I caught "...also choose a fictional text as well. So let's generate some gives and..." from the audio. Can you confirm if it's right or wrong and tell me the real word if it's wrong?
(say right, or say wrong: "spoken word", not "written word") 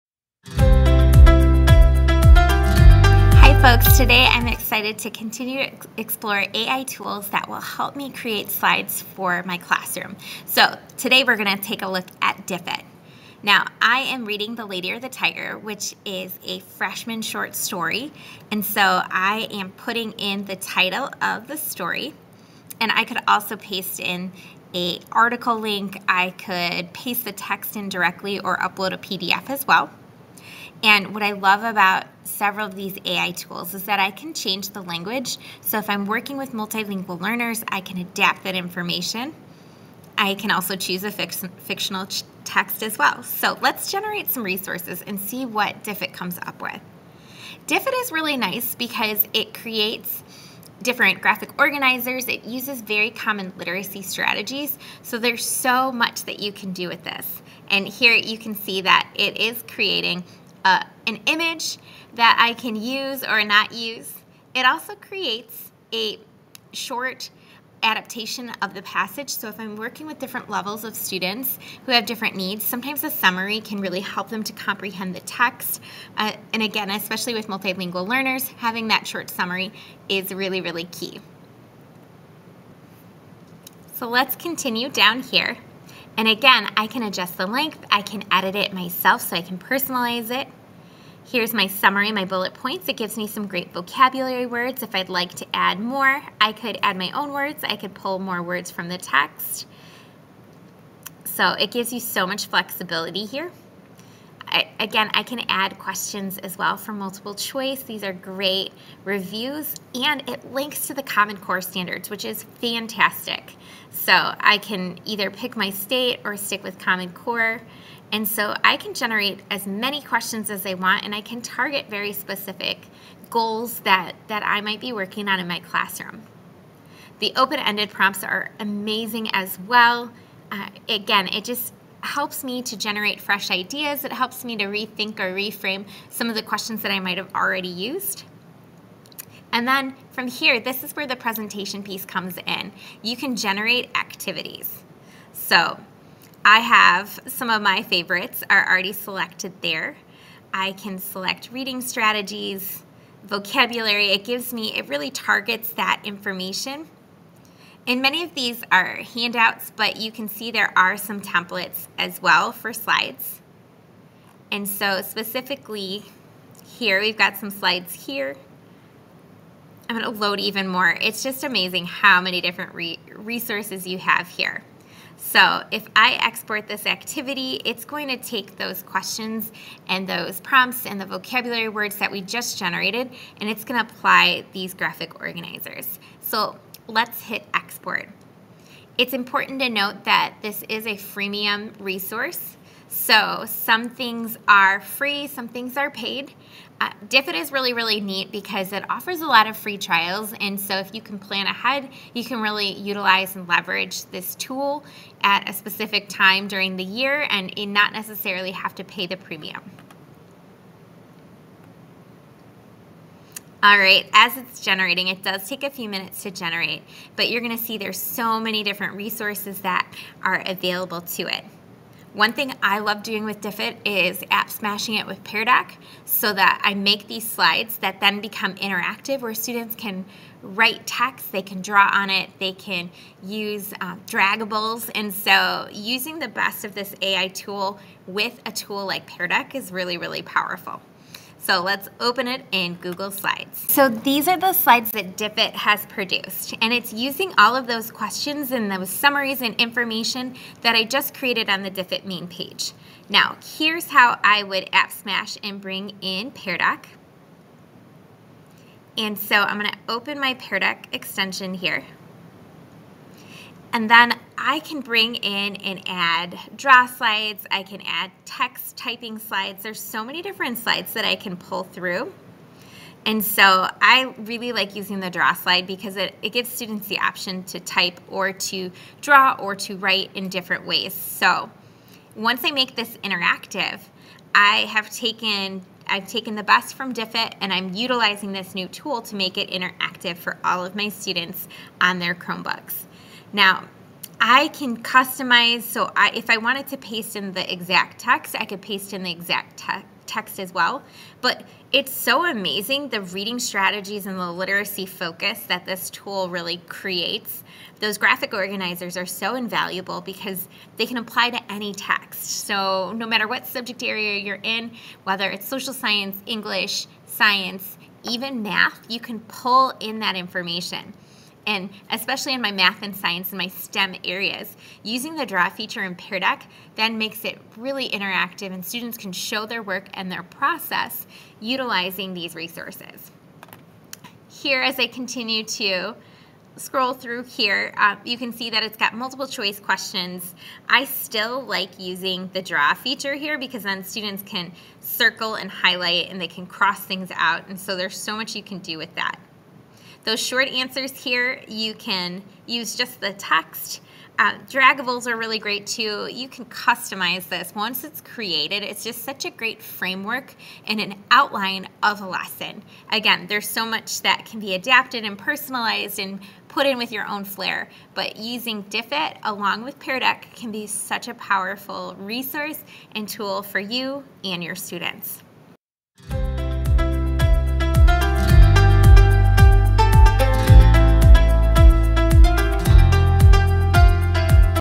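wrong: "resources", not "gives".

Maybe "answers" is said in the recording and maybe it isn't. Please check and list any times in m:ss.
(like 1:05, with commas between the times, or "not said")
5:50.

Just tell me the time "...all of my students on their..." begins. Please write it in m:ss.
4:50.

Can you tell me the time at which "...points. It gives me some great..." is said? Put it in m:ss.
1:32.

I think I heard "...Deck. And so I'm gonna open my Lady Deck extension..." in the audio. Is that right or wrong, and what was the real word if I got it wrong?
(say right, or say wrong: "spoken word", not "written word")
wrong: "Pear", not "Lady".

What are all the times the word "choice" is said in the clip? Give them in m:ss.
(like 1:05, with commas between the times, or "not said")
1:47, 5:39.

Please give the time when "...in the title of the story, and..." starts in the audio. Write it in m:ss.
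0:20.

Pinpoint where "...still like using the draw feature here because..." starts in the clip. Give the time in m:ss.
5:40.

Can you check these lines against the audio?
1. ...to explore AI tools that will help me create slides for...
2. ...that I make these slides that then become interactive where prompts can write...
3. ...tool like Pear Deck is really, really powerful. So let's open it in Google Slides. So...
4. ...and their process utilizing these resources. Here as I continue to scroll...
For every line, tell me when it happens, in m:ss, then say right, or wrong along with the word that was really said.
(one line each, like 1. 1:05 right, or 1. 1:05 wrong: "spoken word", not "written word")
1. 0:05 right
2. 3:46 wrong: "students", not "prompts"
3. 3:58 right
4. 5:29 right.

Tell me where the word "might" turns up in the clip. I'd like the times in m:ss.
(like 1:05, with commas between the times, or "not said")
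2:04, 2:16.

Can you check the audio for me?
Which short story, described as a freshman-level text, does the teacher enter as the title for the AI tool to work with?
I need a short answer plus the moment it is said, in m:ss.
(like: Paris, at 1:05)
The Lady or the Tiger, at 0:14.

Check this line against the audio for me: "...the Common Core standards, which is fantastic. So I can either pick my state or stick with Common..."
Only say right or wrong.
right.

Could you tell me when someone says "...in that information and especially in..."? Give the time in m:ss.
5:19.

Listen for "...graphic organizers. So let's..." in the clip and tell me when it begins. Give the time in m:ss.
3:04.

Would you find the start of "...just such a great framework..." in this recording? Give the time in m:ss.
5:58.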